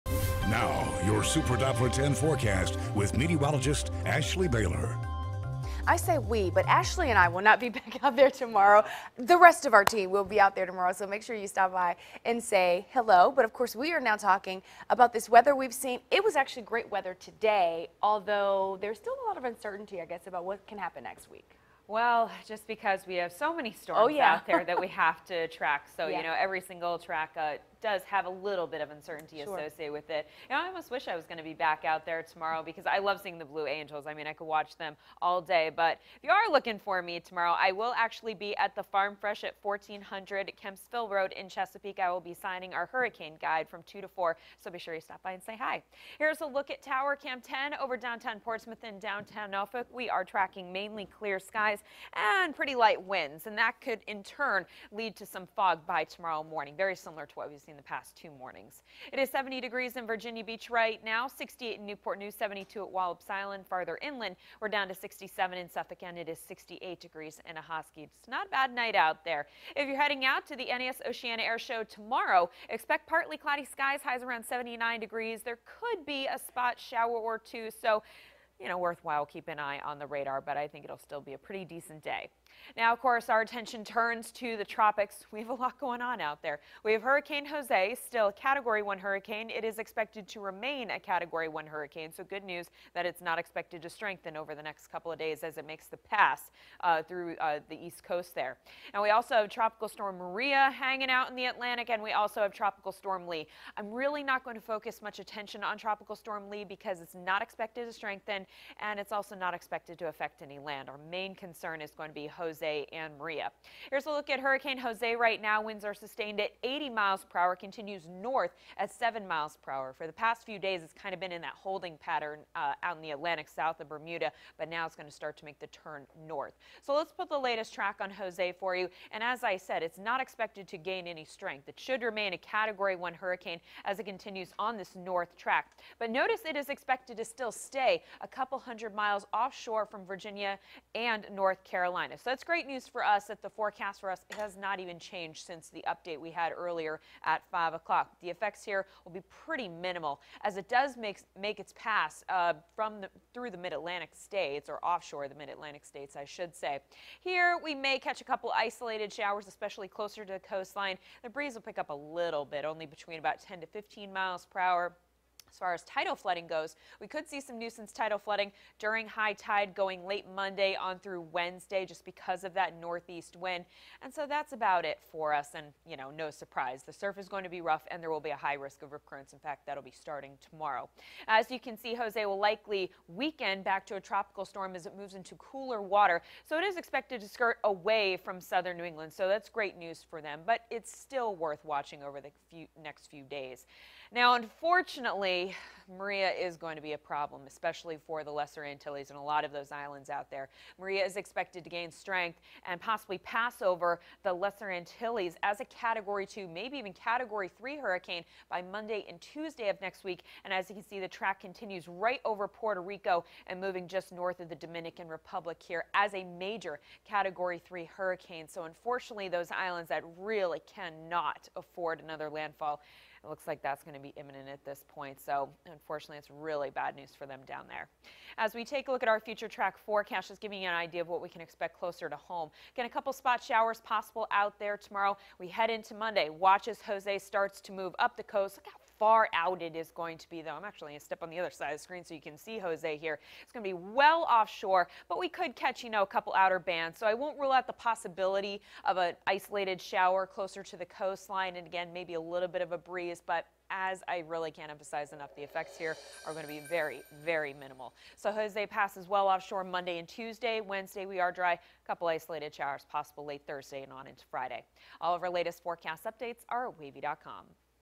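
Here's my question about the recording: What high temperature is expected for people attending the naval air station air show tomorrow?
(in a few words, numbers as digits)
79 degrees.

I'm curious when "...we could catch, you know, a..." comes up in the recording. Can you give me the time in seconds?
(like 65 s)
245 s.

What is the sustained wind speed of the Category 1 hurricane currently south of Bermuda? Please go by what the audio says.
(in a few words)
80 miles per hour.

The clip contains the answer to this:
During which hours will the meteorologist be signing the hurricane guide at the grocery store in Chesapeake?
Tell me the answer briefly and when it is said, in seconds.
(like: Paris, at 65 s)
2 to 4, at 43 s.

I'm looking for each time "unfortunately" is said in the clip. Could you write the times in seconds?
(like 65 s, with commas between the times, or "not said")
194 s, 218 s, 225 s.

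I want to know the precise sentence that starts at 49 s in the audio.
We are tracking mainly clear skies and pretty light winds, and that could in turn lead to some fog by tomorrow morning.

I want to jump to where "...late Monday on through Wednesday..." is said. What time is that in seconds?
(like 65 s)
170 s.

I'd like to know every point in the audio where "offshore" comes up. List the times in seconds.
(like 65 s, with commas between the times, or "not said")
139 s, 154 s, 244 s, 259 s.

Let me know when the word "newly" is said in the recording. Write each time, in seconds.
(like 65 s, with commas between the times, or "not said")
not said.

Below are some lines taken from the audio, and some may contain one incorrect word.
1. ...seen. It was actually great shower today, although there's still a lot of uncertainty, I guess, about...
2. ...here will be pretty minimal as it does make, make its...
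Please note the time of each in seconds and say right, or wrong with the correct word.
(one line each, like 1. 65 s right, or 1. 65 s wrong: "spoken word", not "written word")
1. 15 s wrong: "weather", not "shower"
2. 148 s right.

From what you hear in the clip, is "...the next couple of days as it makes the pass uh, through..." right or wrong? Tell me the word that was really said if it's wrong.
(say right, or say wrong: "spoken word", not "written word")
right.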